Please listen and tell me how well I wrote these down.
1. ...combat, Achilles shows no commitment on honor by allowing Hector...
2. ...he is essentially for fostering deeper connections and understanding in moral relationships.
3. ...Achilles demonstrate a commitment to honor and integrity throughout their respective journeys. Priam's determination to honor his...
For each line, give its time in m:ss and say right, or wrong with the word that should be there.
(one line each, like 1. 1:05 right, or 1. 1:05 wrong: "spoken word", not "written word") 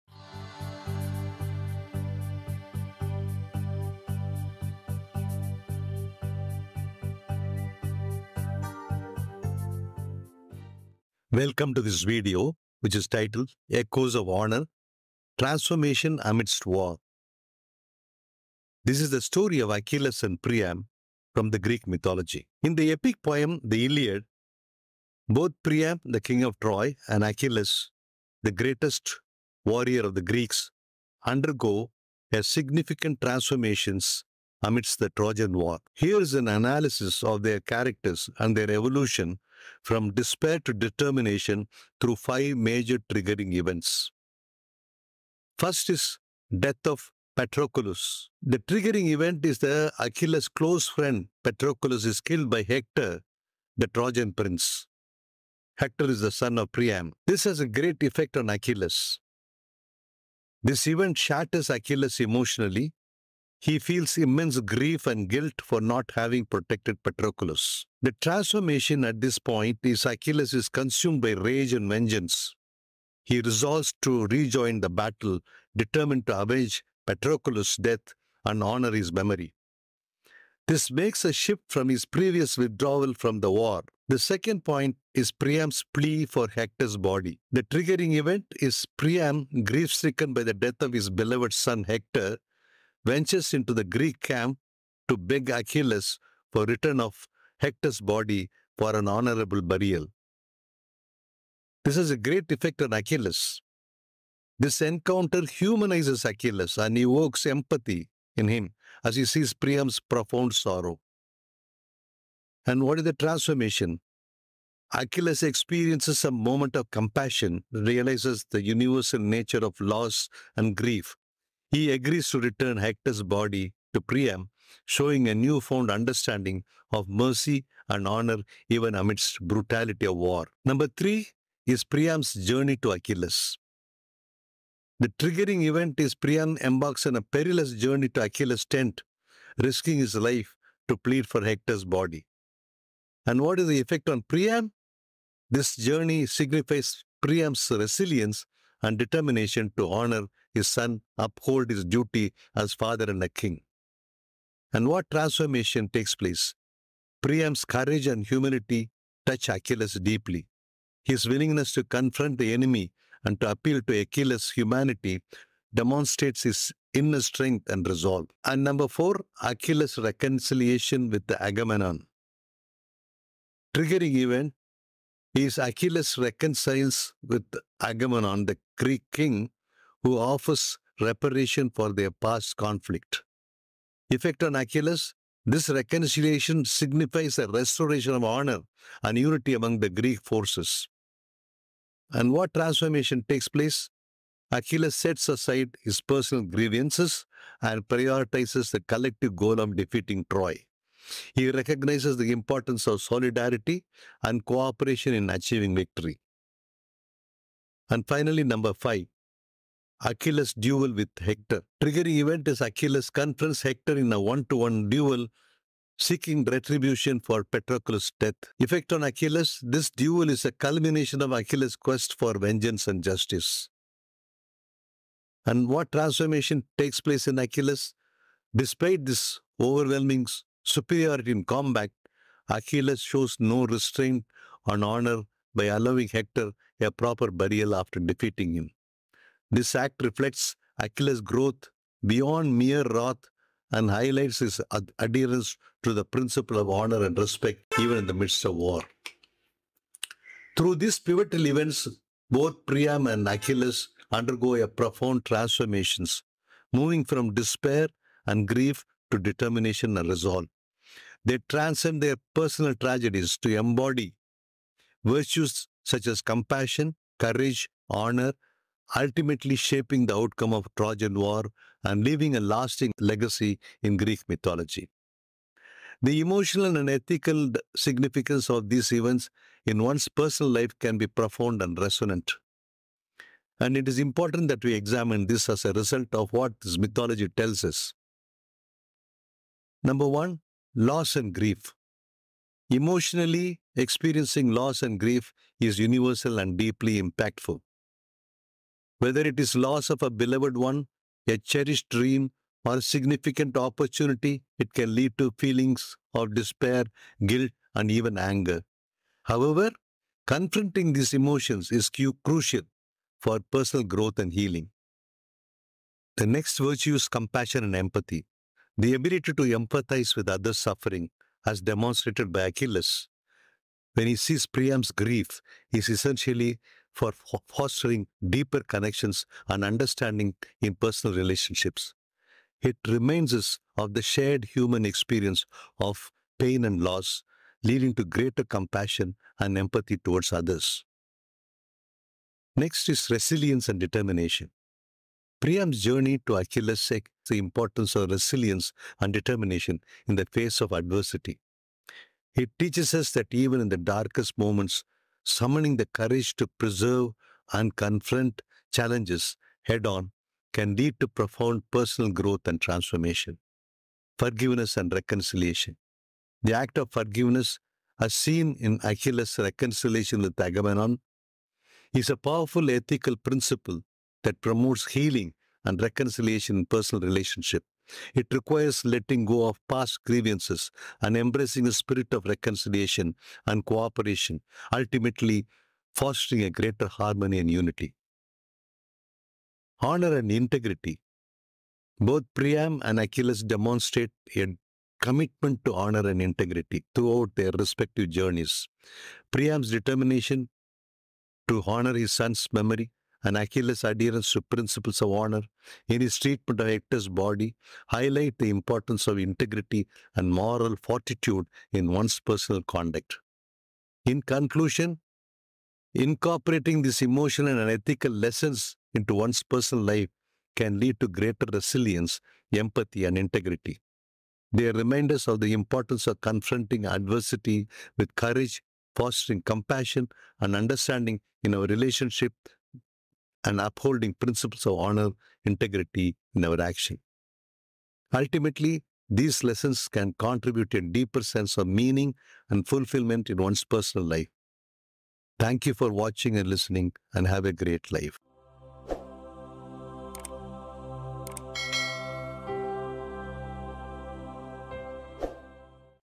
1. 3:51 wrong: "restraint", not "commitment"
2. 5:25 wrong: "personal", not "moral"
3. 6:32 right.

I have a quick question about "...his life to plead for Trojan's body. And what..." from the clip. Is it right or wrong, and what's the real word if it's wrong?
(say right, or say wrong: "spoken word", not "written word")
wrong: "Hector", not "Trojan".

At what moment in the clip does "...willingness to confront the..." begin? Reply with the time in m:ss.
2:41.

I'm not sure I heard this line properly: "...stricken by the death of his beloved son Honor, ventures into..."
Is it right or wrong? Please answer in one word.
wrong.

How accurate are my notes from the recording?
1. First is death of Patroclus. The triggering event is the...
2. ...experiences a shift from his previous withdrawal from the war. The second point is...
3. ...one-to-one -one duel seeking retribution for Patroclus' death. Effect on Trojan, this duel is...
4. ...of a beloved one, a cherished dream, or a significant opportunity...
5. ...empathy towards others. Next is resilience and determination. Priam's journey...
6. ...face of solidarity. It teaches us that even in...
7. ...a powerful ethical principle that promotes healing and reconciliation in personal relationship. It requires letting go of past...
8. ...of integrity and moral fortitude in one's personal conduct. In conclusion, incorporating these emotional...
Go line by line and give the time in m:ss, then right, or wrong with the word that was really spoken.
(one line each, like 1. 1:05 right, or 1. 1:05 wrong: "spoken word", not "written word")
1. 0:45 right
2. 1:20 wrong: "makes", not "experiences"
3. 3:34 wrong: "Achilles", not "Trojan"
4. 4:59 right
5. 5:39 right
6. 5:50 wrong: "adversity", not "solidarity"
7. 6:12 right
8. 6:49 right.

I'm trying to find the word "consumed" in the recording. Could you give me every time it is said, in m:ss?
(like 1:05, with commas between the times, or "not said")
1:10.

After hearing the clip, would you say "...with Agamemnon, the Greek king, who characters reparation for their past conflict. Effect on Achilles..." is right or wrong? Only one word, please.
wrong.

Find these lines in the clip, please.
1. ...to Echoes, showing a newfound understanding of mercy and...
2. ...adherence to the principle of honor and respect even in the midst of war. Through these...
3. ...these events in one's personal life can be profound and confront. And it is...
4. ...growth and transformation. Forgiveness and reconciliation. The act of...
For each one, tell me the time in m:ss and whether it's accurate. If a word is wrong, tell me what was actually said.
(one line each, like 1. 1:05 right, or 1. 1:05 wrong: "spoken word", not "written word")
1. 2:03 wrong: "Priam", not "Echoes"
2. 4:04 right
3. 4:38 wrong: "resonant", not "confront"
4. 6:02 right.